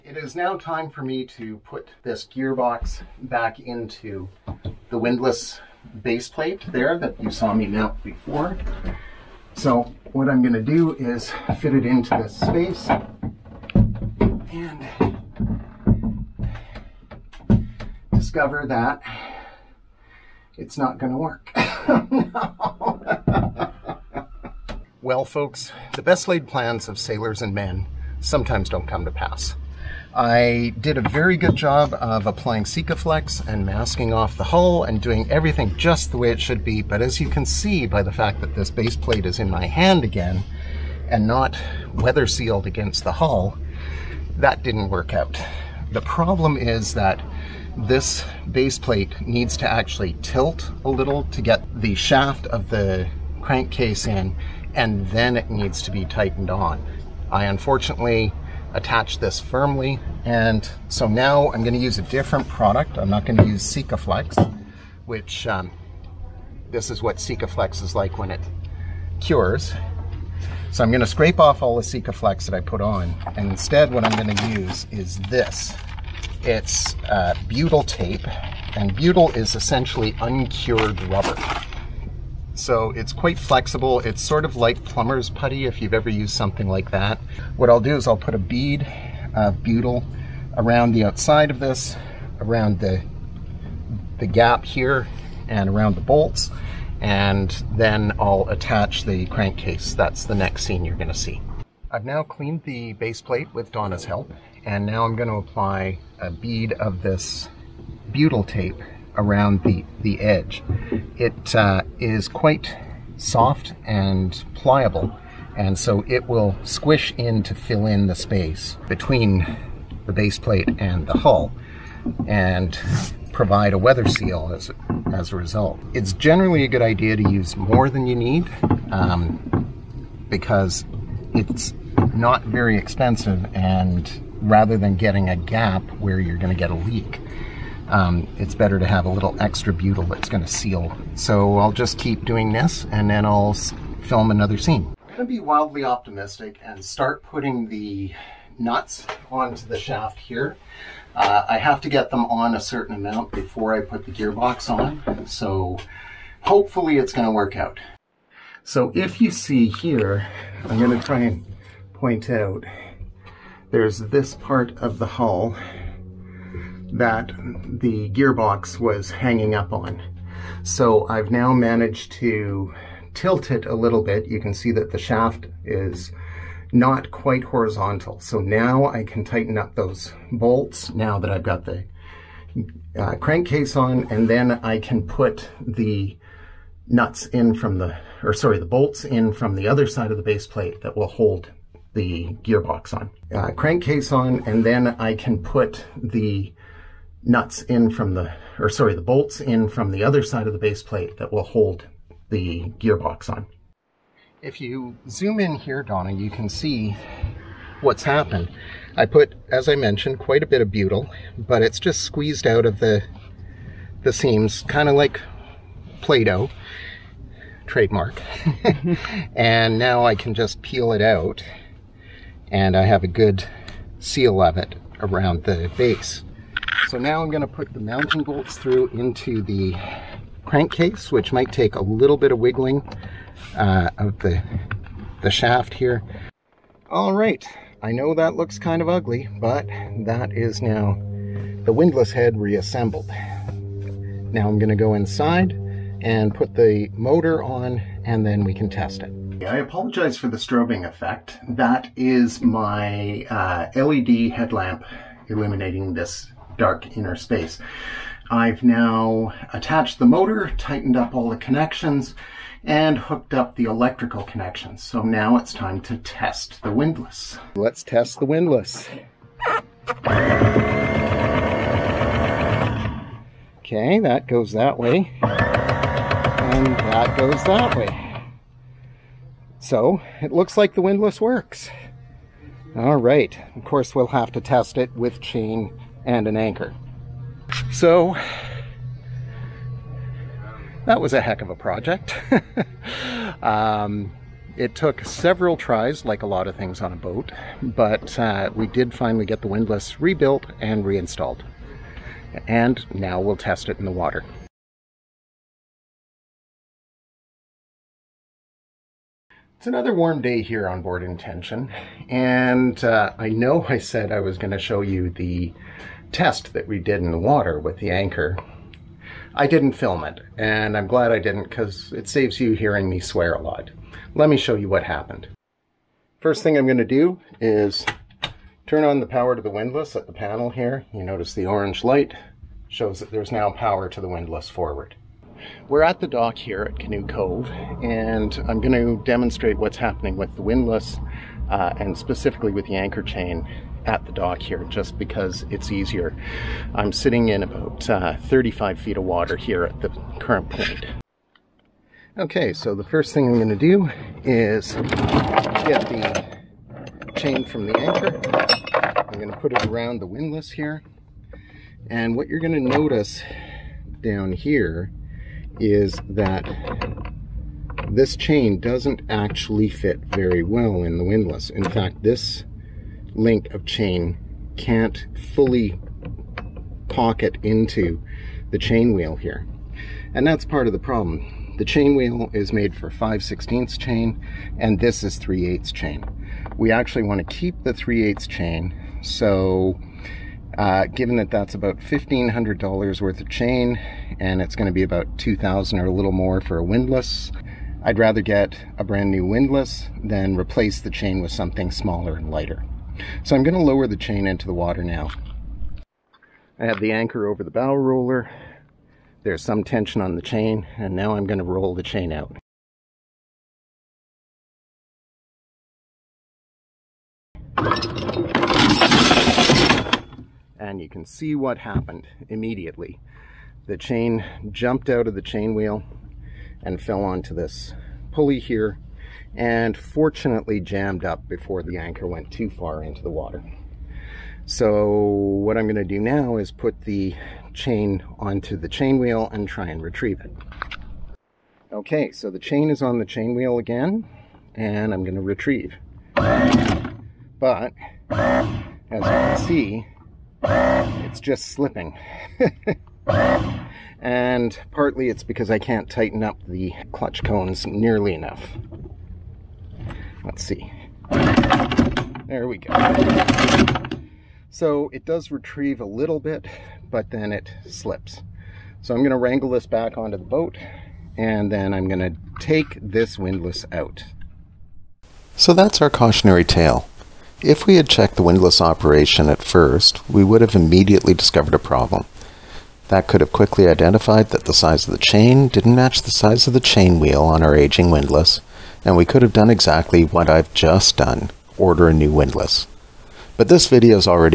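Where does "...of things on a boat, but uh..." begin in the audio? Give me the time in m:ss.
4:56.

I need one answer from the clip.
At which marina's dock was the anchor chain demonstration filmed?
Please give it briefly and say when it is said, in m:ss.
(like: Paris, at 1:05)
Canoe Cove, at 5:36.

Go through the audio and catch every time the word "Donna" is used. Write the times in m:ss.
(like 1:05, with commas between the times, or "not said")
1:43, 3:25.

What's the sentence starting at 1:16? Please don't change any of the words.
It's uh, butyl tape, and butyl is essentially uncured rubber.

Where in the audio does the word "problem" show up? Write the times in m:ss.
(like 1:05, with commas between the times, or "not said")
0:46, 6:20, 8:01.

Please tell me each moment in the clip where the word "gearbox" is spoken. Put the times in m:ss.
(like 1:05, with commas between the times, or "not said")
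0:02, 2:34, 2:48, 3:12, 3:22.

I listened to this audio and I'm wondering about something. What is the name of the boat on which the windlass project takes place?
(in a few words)
Intention.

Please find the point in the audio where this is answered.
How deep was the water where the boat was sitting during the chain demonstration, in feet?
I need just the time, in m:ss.
5:48.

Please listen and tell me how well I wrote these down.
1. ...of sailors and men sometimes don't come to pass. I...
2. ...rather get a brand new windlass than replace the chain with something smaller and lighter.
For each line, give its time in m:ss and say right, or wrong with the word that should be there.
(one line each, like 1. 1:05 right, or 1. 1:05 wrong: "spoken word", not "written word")
1. 0:26 right
2. 6:37 right.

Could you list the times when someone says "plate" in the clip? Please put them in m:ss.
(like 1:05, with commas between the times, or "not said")
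0:06, 0:38, 0:48, 1:43, 2:00, 3:10, 3:20.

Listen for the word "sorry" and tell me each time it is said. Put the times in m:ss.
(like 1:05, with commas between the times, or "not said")
3:08, 3:18.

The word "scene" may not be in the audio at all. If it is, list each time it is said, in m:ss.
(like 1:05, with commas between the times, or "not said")
1:40, 2:24.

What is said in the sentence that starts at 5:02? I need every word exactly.
And now we'll test it in the water.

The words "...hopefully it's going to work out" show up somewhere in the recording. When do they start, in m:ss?
2:36.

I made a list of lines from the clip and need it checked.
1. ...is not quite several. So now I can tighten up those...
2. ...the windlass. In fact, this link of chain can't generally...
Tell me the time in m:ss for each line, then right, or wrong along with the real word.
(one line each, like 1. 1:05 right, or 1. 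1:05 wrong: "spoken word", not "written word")
1. 2:55 wrong: "horizontal", not "several"
2. 6:10 wrong: "fully", not "generally".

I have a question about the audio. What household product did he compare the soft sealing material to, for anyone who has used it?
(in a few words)
plumber's putty.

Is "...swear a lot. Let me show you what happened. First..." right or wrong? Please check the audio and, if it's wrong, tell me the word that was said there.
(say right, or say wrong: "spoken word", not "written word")
right.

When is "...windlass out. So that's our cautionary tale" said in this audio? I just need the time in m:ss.
7:53.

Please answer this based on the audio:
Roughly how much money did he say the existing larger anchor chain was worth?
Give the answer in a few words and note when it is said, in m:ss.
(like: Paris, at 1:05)
$1,500, at 6:31.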